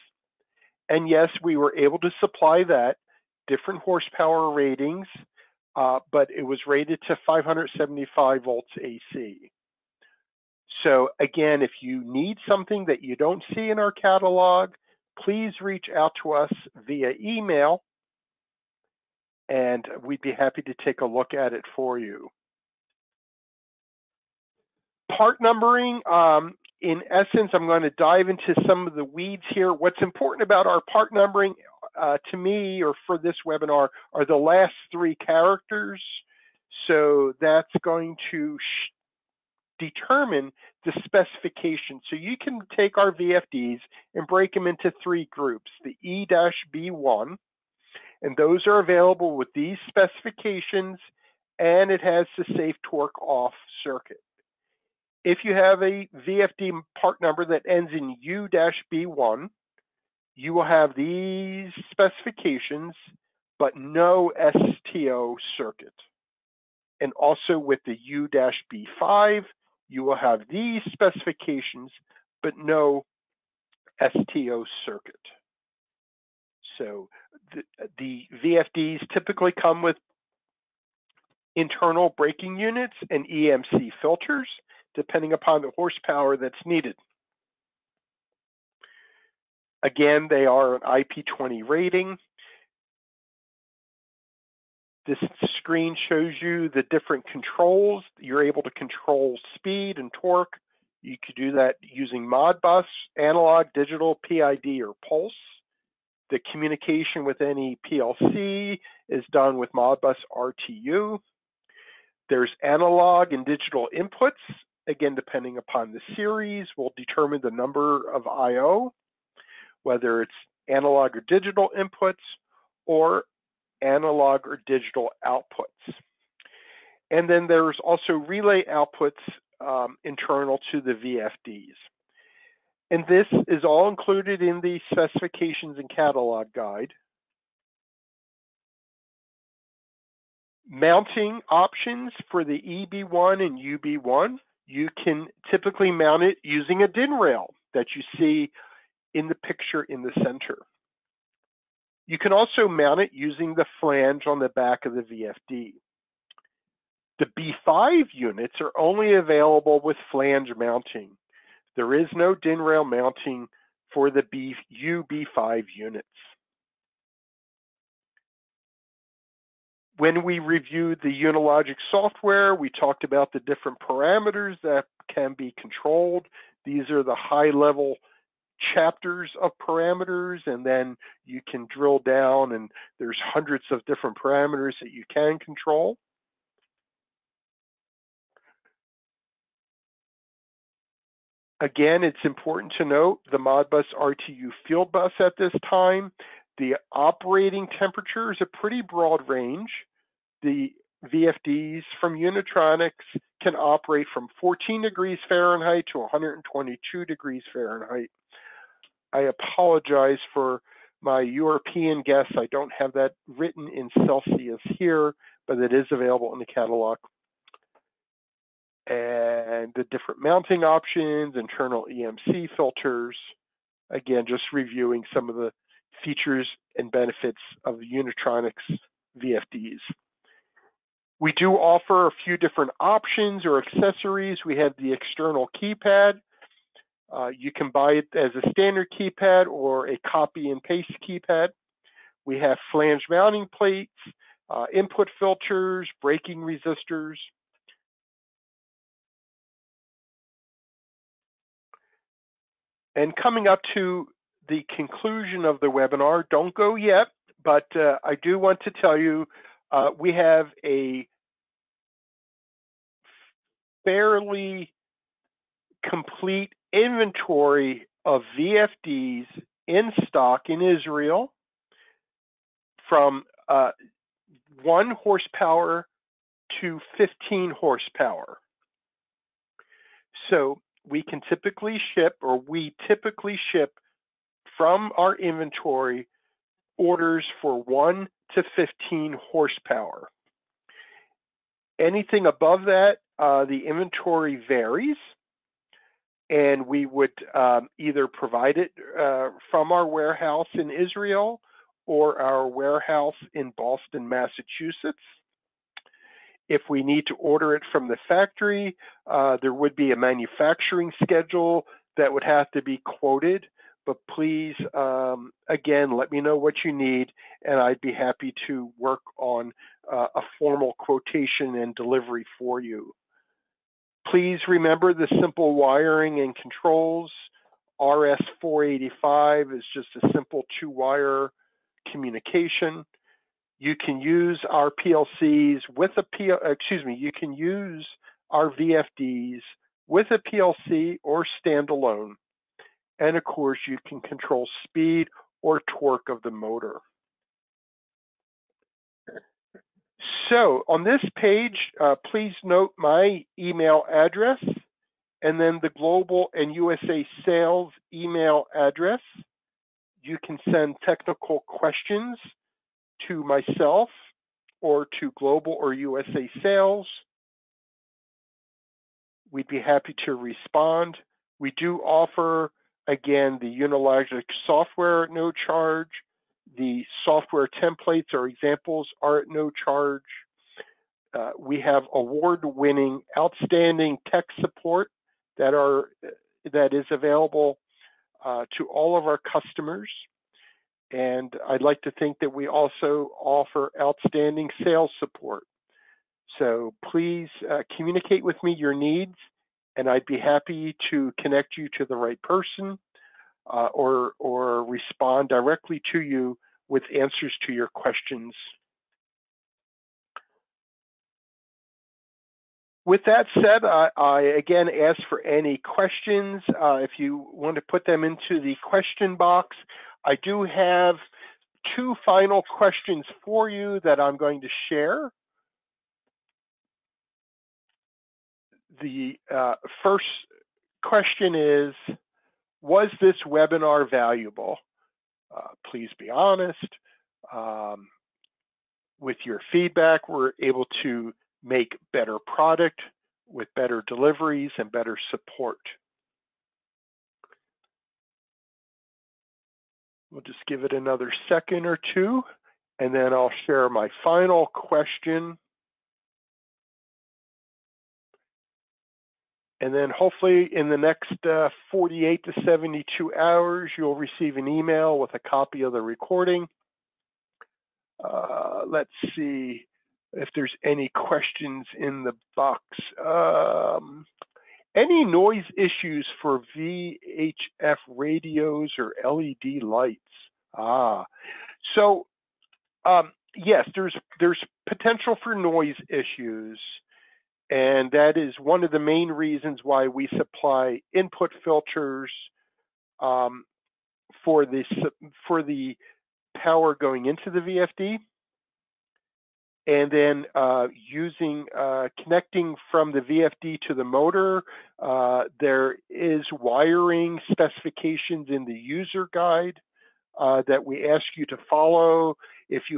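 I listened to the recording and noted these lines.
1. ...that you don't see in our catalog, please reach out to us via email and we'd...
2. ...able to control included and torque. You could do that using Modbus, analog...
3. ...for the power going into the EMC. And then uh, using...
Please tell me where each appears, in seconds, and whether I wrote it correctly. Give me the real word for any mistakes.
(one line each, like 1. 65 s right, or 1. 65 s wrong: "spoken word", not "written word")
1. 12 s right
2. 98 s wrong: "speed", not "included"
3. 495 s wrong: "VFD", not "EMC".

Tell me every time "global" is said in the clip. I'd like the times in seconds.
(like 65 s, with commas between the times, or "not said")
355 s, 365 s.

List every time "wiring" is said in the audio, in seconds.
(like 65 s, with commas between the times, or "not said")
325 s, 506 s.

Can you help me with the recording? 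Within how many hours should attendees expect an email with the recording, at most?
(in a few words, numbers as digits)
72.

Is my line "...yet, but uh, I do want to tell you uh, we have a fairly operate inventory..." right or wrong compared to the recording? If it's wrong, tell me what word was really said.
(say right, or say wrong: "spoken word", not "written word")
wrong: "complete", not "operate".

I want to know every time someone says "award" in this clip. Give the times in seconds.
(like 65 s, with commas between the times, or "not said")
381 s.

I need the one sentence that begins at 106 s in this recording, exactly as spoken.
The communication with any PLC is done with Modbus RTU.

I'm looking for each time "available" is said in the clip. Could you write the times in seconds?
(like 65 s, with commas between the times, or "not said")
48 s, 159 s, 215 s, 386 s.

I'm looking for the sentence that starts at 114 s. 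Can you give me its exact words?
Again, depending upon the series, will determine the number of I.O whether it's analog or digital inputs or analog or digital outputs.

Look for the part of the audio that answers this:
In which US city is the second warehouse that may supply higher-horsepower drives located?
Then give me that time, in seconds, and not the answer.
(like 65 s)
303 s.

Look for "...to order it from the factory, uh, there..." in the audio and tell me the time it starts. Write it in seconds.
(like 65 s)
307 s.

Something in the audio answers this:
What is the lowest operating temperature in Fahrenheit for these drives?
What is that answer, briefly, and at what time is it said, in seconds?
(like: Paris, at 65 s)
14 degrees Fahrenheit, at 204 s.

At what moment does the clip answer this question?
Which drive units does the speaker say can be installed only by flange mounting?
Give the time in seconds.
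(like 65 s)
157 s.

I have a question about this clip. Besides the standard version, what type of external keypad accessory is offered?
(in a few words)
copy and paste keypad.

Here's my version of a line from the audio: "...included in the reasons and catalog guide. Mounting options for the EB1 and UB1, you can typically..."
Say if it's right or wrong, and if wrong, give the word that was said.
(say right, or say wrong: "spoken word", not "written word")
wrong: "specifications", not "reasons".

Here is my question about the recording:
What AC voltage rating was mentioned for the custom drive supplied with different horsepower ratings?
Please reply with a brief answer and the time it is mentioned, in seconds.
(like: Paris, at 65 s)
575 volts, at 7 s.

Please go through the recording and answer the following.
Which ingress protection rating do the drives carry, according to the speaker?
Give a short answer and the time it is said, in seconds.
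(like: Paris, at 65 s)
IP20, at 90 s.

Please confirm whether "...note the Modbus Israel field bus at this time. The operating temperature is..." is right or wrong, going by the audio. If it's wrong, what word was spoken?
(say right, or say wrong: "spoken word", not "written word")
wrong: "RTU", not "Israel".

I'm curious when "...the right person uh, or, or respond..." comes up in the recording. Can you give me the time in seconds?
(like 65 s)
401 s.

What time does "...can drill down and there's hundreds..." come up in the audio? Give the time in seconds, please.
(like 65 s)
181 s.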